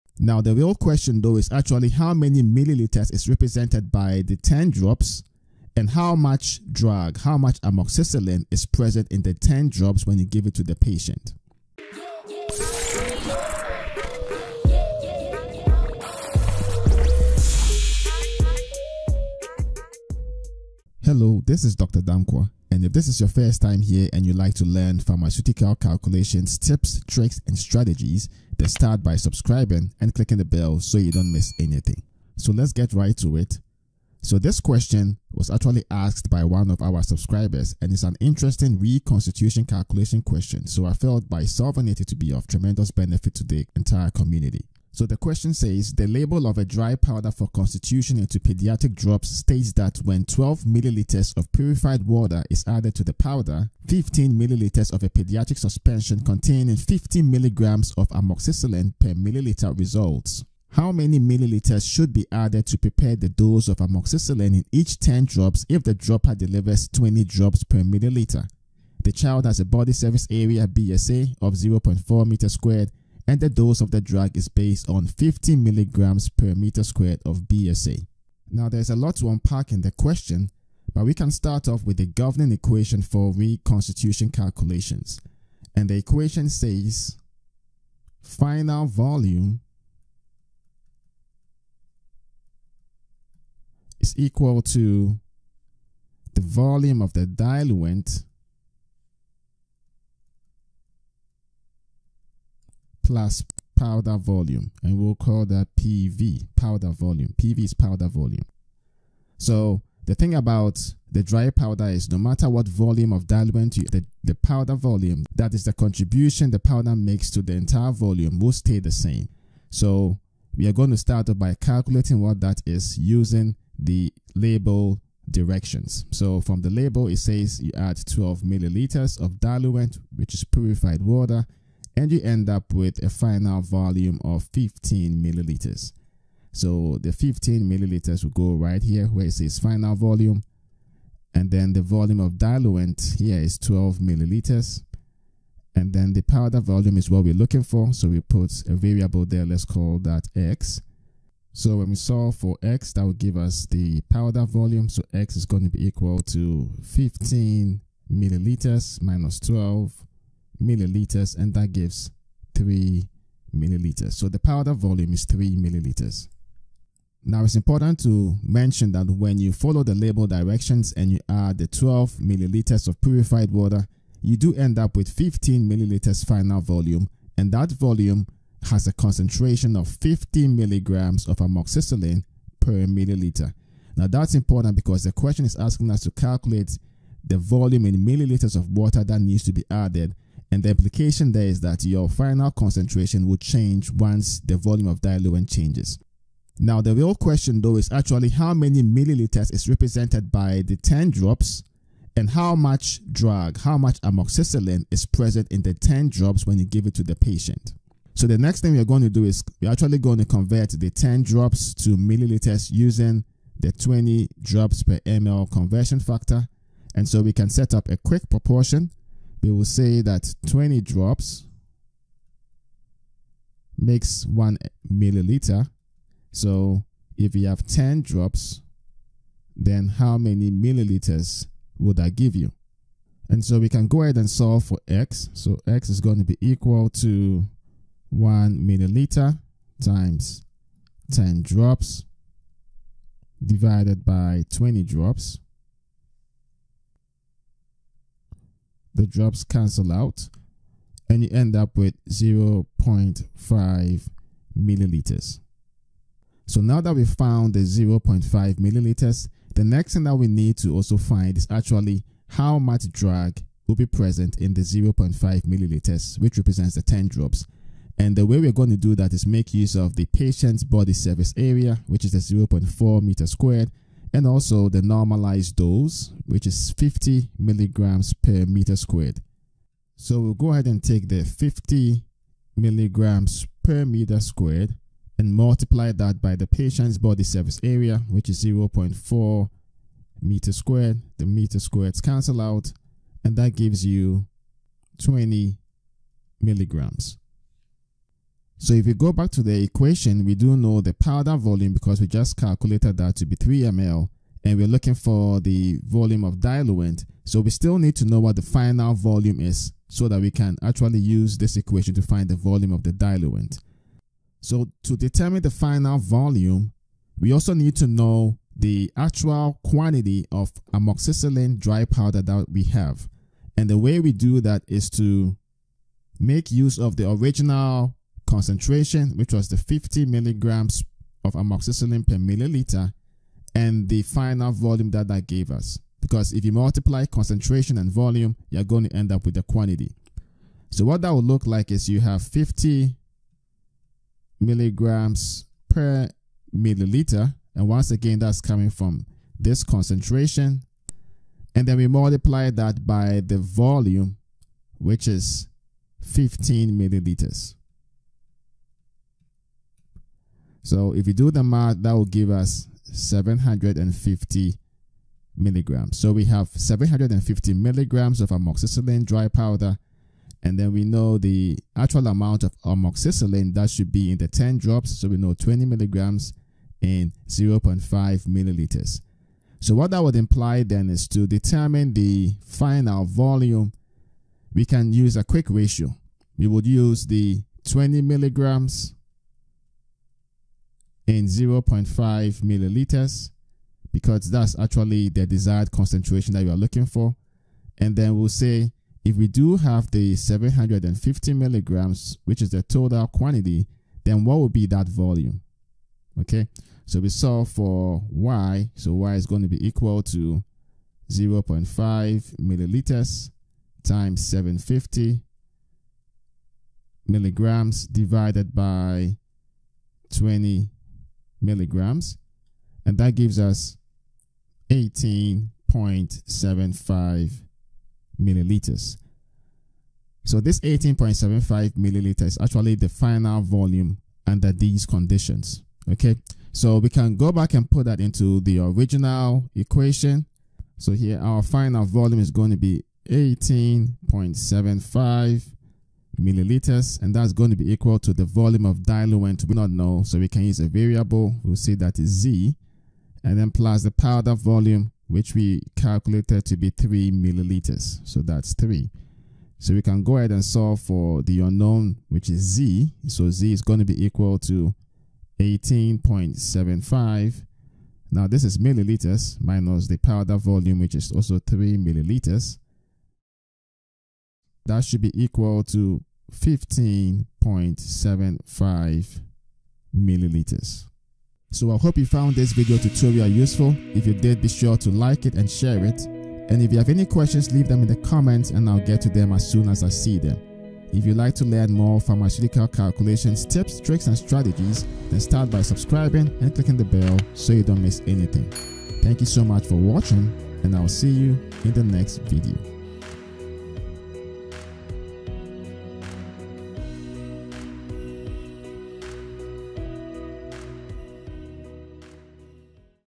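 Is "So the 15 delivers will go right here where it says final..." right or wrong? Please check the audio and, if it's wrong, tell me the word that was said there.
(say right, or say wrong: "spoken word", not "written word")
wrong: "milliliters", not "delivers".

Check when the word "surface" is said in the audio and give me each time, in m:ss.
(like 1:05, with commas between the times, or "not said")
1:09, 4:30, 4:47.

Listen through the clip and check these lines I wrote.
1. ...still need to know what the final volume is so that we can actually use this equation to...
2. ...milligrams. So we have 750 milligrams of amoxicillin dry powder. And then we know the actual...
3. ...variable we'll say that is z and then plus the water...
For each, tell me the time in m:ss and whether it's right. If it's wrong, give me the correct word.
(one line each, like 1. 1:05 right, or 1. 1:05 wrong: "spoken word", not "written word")
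1. 5:07 right
2. 6:05 right
3. 7:30 wrong: "powder", not "water".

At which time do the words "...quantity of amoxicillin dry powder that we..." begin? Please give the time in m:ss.
5:19.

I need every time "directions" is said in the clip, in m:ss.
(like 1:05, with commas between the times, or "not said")
2:05, 2:50.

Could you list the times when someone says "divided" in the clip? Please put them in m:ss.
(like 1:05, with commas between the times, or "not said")
4:03, 6:57.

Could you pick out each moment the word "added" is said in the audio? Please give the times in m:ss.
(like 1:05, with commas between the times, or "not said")
0:52, 1:02, 3:09.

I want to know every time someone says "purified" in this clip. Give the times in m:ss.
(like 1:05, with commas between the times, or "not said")
0:51, 2:10, 2:53.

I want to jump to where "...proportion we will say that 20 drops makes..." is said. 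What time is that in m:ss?
3:38.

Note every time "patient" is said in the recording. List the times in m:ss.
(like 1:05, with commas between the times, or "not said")
0:10, 3:27, 4:30, 4:46.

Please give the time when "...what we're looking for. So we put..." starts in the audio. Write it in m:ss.
2:27.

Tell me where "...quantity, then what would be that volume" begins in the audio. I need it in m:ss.
6:43.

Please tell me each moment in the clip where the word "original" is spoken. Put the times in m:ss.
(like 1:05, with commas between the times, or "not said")
5:27, 7:18.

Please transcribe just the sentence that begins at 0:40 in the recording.
So I felt by solving it, it to be of tremendous benefit to the entire community.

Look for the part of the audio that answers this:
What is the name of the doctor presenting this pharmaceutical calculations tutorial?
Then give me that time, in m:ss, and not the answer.
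0:21.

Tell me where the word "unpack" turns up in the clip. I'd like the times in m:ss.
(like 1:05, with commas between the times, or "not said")
1:19.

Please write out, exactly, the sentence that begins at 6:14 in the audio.
So we know 20 milligrams in 0.5 milliliters.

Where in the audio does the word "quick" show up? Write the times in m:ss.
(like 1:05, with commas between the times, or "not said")
3:37, 6:25.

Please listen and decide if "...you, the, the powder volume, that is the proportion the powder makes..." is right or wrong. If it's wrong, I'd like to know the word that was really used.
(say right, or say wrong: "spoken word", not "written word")
wrong: "contribution", not "proportion".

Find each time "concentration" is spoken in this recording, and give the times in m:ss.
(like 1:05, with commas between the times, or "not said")
2:58, 3:12, 5:28, 5:37, 5:49, 6:35.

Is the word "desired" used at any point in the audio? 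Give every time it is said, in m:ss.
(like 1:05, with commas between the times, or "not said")
6:35.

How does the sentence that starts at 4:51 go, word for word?
The meter squareds cancel out, and that gives you 20 milligrams.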